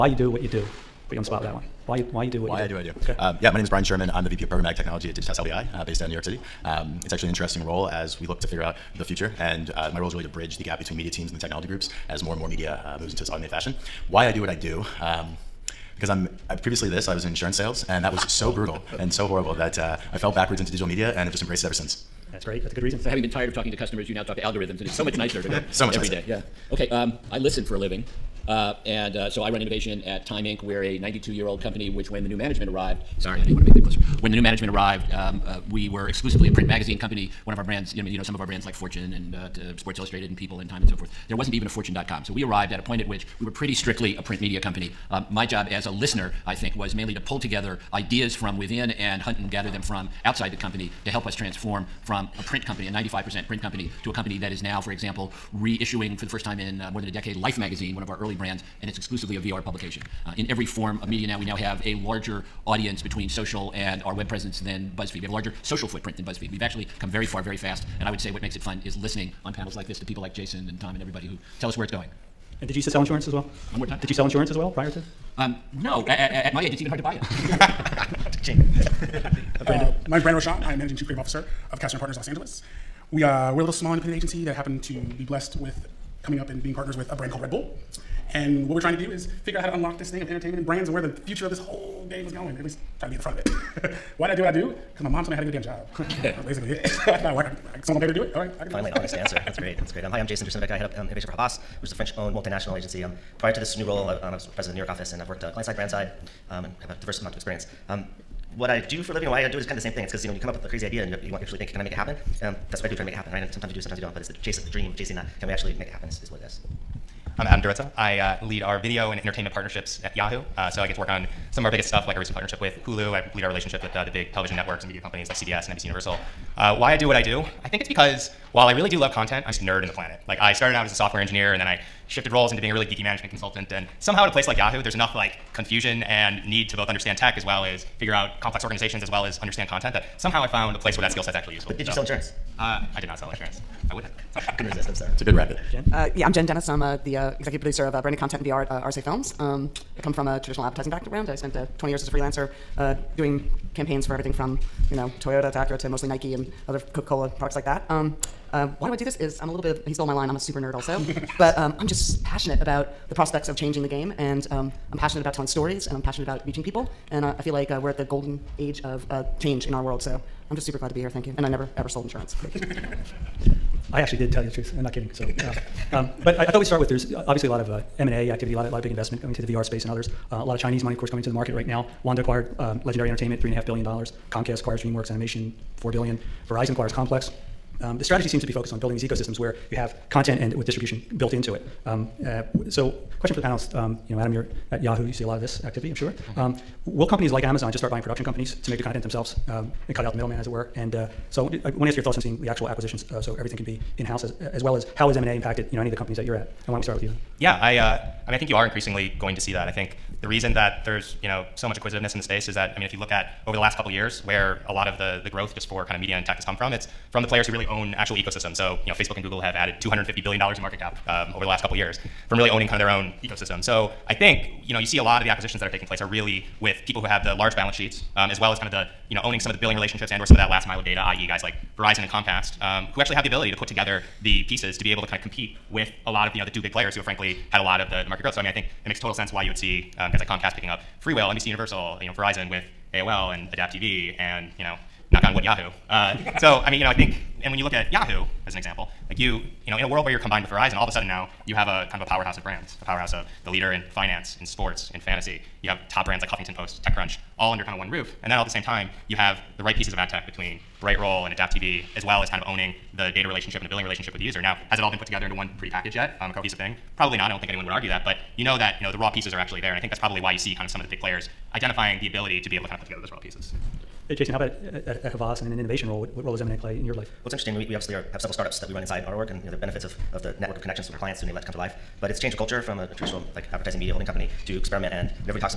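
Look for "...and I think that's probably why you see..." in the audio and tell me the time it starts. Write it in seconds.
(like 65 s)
269 s.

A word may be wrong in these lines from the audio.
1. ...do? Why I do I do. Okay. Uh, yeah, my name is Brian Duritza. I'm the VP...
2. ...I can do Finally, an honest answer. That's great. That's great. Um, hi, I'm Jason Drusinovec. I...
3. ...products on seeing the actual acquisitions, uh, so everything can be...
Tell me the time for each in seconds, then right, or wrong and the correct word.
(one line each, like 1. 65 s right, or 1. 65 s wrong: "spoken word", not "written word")
1. 2 s wrong: "Sherman", not "Duritza"
2. 98 s right
3. 202 s wrong: "thoughts", not "products".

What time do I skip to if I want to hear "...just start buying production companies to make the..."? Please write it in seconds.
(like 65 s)
197 s.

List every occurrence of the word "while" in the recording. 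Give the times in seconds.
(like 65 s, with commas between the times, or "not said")
128 s.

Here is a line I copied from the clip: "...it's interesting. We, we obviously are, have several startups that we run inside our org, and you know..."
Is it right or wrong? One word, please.
right.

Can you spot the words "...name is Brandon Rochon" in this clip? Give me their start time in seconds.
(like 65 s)
80 s.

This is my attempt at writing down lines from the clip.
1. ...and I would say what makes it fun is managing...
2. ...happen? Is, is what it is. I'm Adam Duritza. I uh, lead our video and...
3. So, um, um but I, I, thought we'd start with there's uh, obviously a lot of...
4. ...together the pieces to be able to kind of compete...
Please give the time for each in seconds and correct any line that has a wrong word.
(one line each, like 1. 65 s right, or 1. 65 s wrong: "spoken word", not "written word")
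1. 67 s wrong: "listening", not "managing"
2. 115 s right
3. 175 s right
4. 233 s right.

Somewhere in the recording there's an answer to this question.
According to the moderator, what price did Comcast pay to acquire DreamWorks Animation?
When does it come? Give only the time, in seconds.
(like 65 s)
185 s.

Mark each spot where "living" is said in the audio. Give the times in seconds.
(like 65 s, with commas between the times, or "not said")
27 s, 109 s.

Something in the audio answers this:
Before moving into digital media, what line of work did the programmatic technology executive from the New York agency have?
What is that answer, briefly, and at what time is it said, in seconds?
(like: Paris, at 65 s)
Insurance sales, at 17 s.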